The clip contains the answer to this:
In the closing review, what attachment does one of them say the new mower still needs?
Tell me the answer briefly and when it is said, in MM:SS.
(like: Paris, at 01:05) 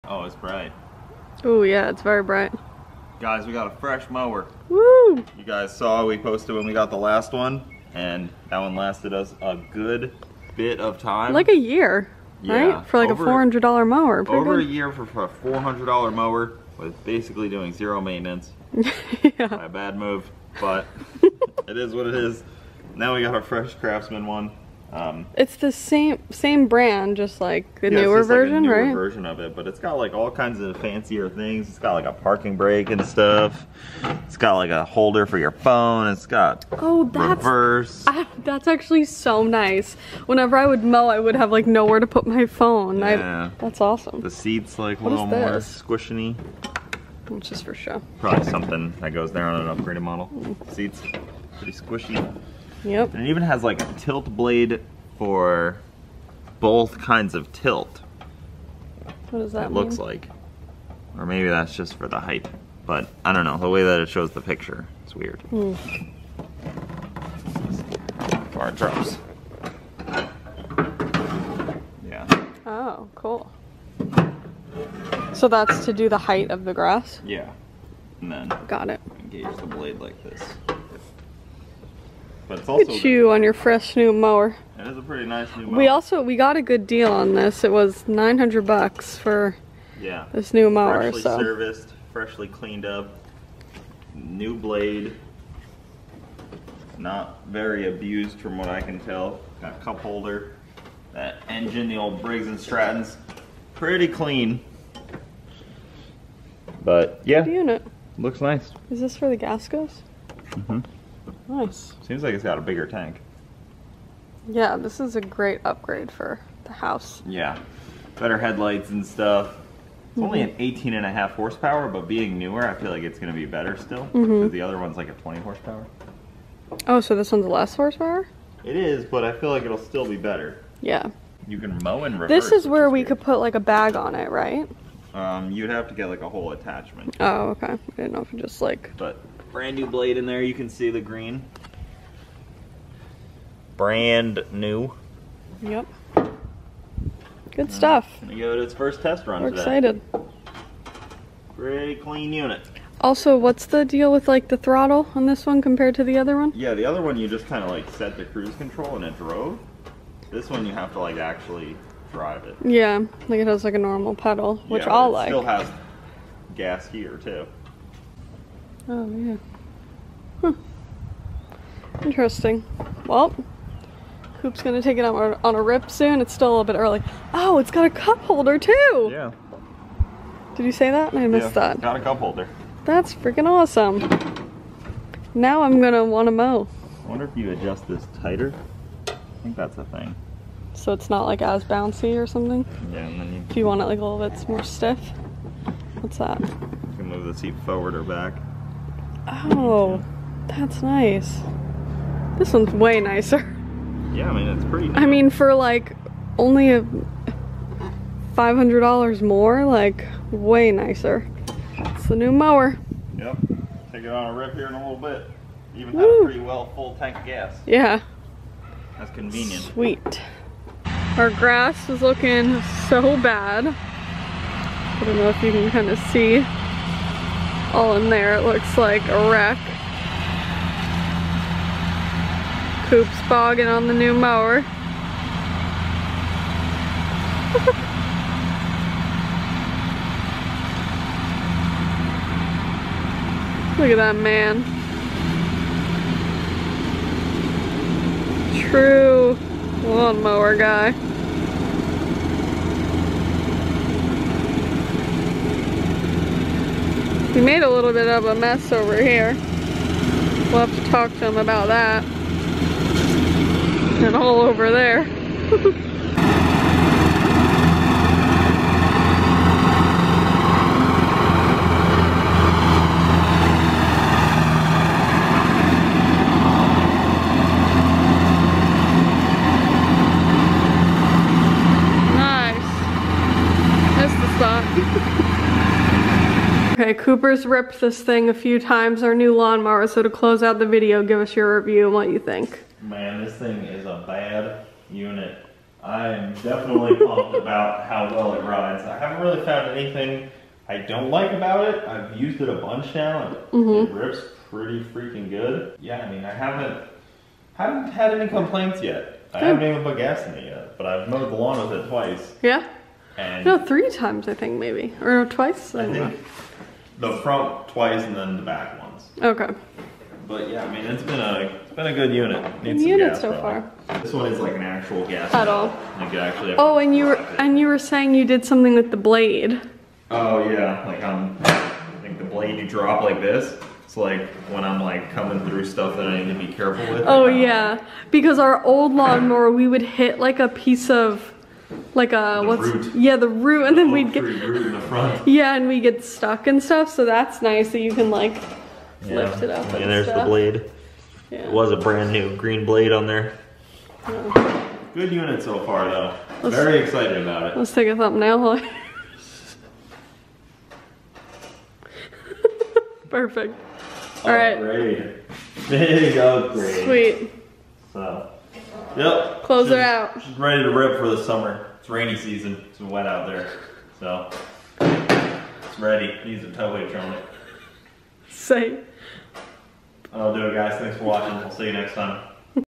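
A tow hitch, at 06:16.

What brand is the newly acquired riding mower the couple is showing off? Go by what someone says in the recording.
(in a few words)
Craftsman.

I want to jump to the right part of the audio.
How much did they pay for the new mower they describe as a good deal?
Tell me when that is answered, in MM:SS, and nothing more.
01:28.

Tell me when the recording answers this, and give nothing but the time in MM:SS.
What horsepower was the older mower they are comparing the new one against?
02:05.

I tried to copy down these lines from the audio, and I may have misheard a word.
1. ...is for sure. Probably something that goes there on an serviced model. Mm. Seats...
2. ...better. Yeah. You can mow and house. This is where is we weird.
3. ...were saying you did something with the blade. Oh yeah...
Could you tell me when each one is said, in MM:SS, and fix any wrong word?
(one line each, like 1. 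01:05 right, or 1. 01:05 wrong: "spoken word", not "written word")
1. 00:47 wrong: "upgraded", not "serviced"
2. 02:10 wrong: "reverse", not "house"
3. 05:27 right.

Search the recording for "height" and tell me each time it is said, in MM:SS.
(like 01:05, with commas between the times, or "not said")
01:02, 01:16.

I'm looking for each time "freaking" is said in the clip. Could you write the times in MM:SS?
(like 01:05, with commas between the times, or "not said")
03:03, 05:04.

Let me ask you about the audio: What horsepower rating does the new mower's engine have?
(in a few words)
18.5.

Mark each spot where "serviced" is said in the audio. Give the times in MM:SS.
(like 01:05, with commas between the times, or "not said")
01:31.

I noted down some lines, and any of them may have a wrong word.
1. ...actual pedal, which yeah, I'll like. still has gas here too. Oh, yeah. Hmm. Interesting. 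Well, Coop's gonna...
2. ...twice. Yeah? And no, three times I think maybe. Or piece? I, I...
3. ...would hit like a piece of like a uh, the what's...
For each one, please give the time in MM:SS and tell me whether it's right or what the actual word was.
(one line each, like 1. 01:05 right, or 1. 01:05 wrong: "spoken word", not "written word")
1. 02:43 wrong: "normal", not "actual"
2. 05:11 wrong: "twice", not "piece"
3. 05:39 right.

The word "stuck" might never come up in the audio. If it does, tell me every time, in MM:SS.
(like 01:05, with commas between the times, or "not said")
05:46.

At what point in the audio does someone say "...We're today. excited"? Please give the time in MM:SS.
02:29.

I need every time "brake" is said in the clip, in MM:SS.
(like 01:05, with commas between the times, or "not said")
00:32.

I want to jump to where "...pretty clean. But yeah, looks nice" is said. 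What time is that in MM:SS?
01:43.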